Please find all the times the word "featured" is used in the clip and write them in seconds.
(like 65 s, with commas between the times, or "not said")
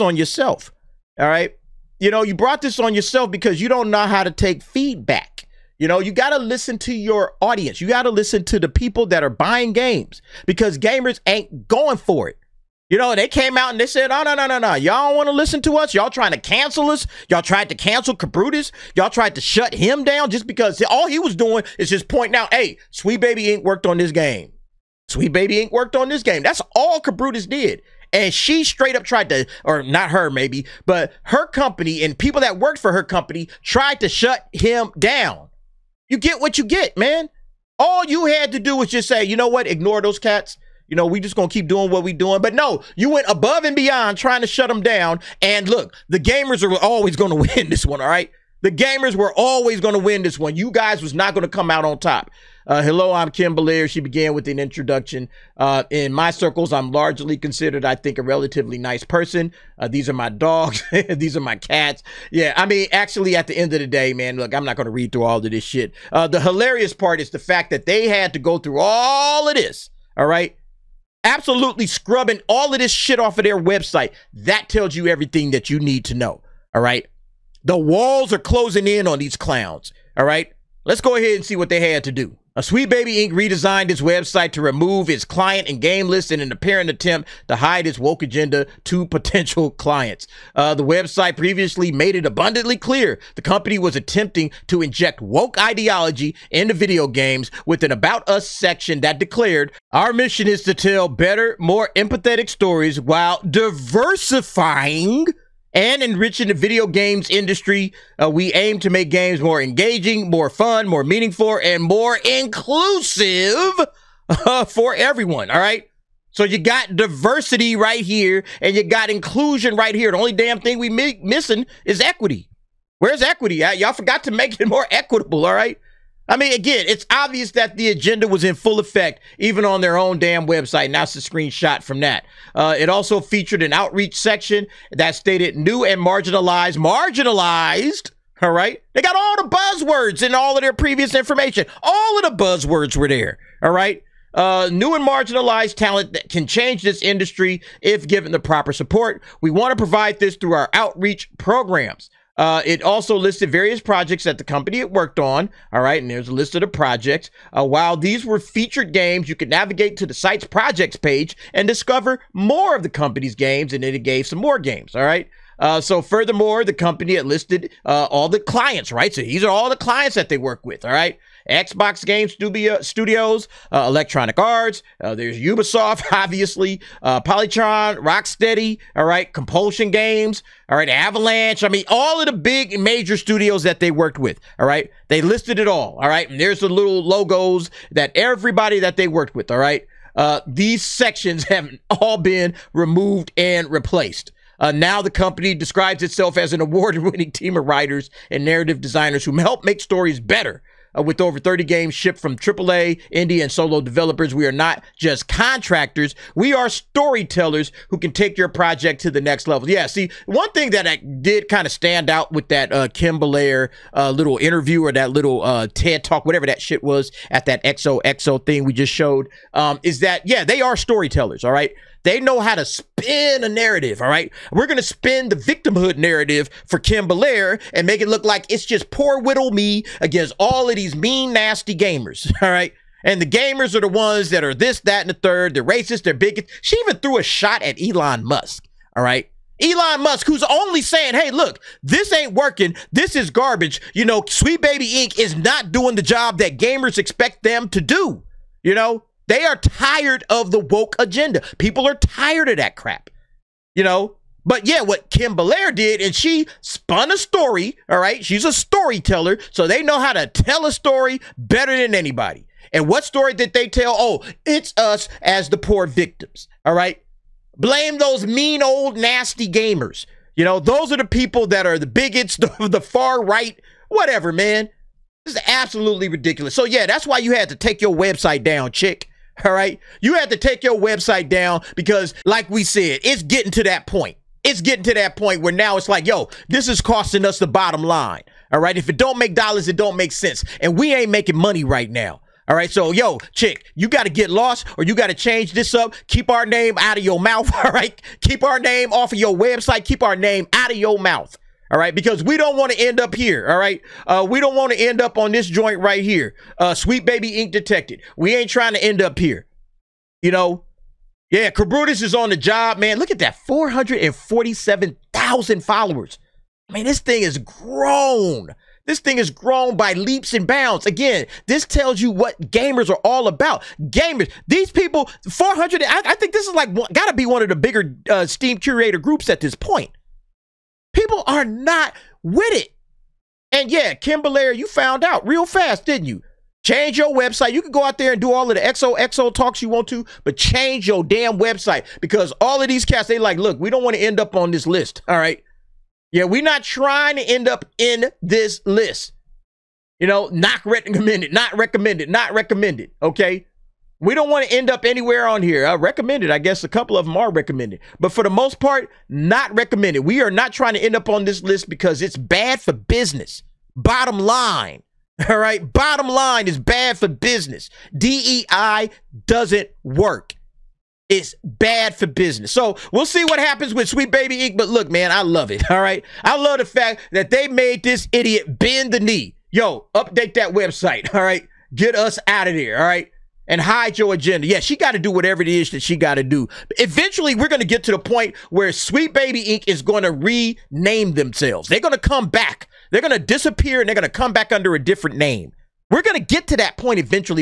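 133 s, 158 s.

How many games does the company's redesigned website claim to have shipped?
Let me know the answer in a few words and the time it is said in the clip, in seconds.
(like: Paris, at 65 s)
Over 30, at 201 s.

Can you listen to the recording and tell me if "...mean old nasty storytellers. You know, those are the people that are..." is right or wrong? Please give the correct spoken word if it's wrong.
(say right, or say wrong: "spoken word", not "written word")
wrong: "gamers", not "storytellers".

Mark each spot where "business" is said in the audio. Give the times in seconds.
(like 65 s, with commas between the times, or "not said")
362 s, 367 s, 372 s.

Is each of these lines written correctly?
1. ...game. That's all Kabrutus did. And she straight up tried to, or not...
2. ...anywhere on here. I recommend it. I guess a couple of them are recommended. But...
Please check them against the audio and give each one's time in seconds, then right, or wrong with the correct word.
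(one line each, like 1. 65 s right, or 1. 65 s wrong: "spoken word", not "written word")
1. 26 s right
2. 354 s right.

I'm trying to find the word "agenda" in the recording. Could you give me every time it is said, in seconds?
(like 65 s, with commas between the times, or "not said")
88 s, 127 s, 250 s, 384 s.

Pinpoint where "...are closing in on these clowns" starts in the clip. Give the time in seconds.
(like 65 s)
78 s.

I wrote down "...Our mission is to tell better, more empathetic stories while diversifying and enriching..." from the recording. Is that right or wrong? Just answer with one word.
right.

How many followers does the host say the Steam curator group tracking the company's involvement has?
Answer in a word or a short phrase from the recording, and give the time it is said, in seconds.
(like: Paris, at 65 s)
447,000, at 313 s.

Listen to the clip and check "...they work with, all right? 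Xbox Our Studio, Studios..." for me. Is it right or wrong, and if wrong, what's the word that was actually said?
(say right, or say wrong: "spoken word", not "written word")
wrong: "Game", not "Our".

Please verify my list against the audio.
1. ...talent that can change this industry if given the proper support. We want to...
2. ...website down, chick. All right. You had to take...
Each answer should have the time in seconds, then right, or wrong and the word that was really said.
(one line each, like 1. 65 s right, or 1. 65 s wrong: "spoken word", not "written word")
1. 145 s right
2. 277 s right.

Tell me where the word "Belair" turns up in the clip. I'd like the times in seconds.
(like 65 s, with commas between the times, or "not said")
53 s, 213 s, 227 s, 255 s, 334 s.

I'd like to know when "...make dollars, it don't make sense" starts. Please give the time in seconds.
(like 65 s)
289 s.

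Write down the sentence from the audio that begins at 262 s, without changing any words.
And what story did they tell?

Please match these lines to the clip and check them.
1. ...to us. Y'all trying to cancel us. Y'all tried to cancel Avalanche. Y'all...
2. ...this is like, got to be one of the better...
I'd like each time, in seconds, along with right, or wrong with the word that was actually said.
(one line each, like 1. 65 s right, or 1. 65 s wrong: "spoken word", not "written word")
1. 15 s wrong: "Kabrutus", not "Avalanche"
2. 326 s wrong: "bigger", not "better".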